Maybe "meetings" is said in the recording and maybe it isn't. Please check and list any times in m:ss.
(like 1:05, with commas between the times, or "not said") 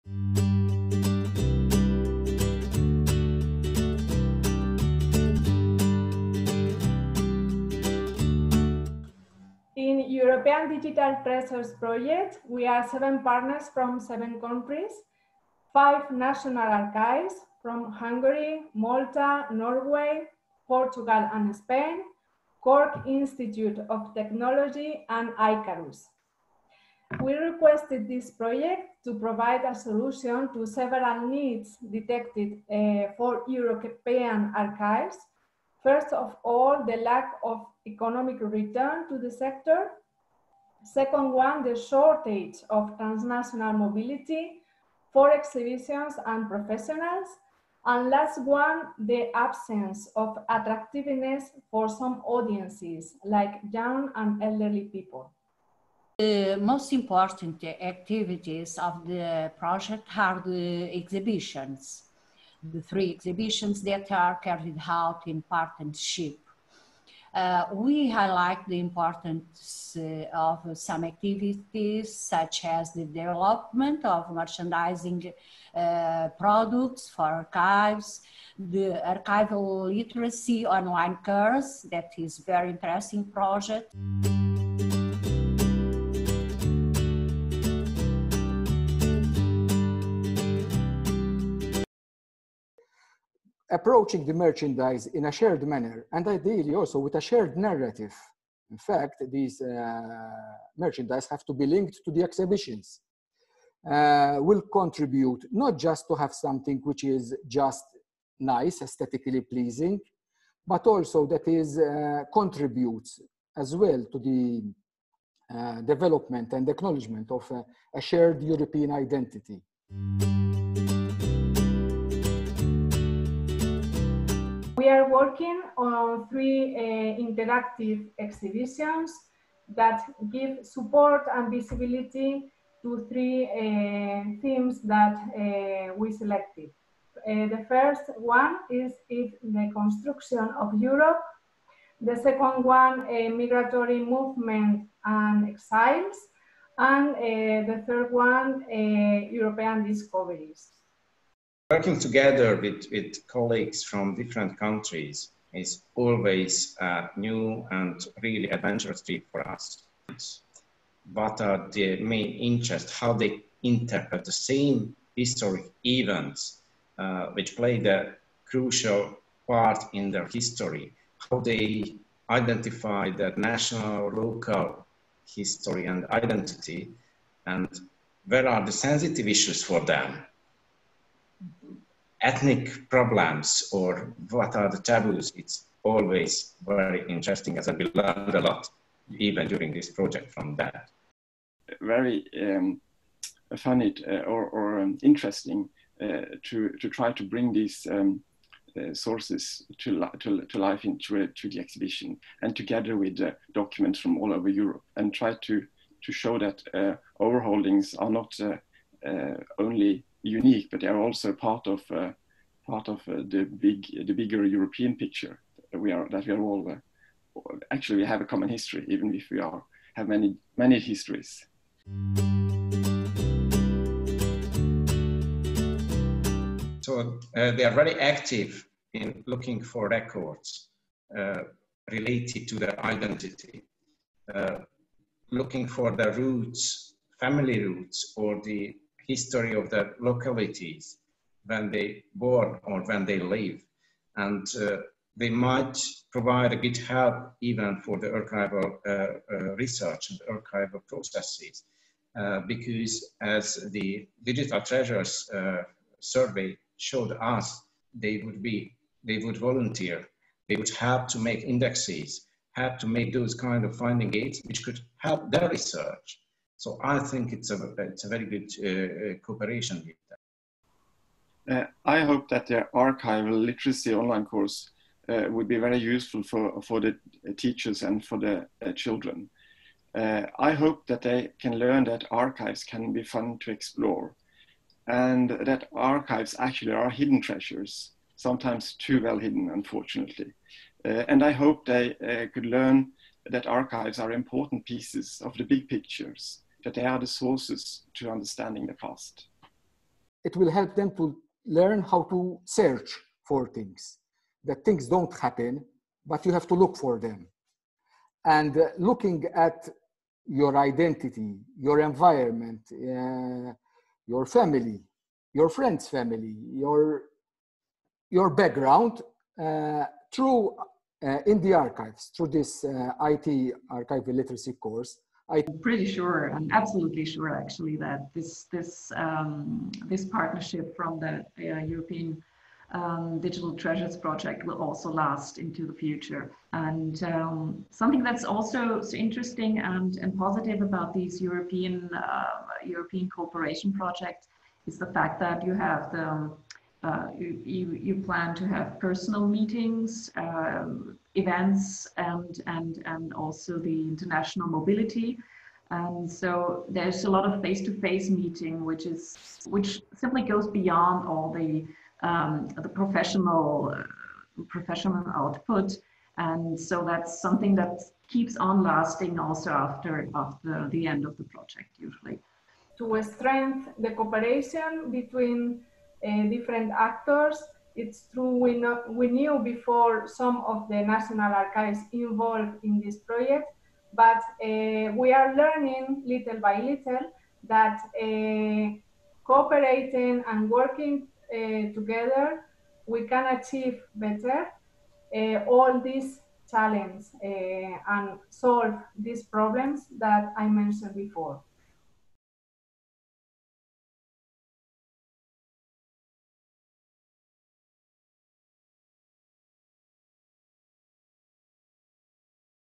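5:49, 5:58.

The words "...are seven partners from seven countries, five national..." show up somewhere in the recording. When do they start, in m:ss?
0:12.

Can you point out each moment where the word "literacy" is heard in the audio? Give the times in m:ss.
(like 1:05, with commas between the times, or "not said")
1:19, 4:33, 5:24.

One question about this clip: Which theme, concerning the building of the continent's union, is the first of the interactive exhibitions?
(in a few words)
The construction of Europe.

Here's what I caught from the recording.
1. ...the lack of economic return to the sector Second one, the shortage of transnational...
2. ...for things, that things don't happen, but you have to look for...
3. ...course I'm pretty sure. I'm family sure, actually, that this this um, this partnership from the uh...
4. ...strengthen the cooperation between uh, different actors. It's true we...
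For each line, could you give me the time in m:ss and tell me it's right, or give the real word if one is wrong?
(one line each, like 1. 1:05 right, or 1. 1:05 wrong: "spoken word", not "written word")
1. 0:36 right
2. 5:03 right
3. 5:24 wrong: "absolutely", not "family"
4. 6:13 right.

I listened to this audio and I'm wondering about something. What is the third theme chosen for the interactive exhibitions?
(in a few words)
European discoveries.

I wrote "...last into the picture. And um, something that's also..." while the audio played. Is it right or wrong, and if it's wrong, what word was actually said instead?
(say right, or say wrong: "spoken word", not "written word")
wrong: "future", not "picture".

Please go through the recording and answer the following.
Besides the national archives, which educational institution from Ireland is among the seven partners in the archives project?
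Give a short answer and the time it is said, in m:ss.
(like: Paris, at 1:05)
Cork Institute of Technology, at 0:22.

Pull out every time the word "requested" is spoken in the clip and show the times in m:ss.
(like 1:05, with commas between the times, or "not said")
0:27.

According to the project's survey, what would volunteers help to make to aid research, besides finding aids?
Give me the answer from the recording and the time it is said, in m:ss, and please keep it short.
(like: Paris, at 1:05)
Indexes, at 4:21.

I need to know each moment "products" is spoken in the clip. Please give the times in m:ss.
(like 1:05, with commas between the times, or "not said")
1:16.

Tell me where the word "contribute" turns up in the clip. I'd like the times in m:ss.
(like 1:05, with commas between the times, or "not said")
1:44, 1:52.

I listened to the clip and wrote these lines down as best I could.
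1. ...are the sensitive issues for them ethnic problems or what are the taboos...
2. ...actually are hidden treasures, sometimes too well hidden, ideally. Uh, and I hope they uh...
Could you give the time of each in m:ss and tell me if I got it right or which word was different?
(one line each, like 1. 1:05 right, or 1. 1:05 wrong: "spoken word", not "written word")
1. 2:58 right
2. 4:46 wrong: "unfortunately", not "ideally".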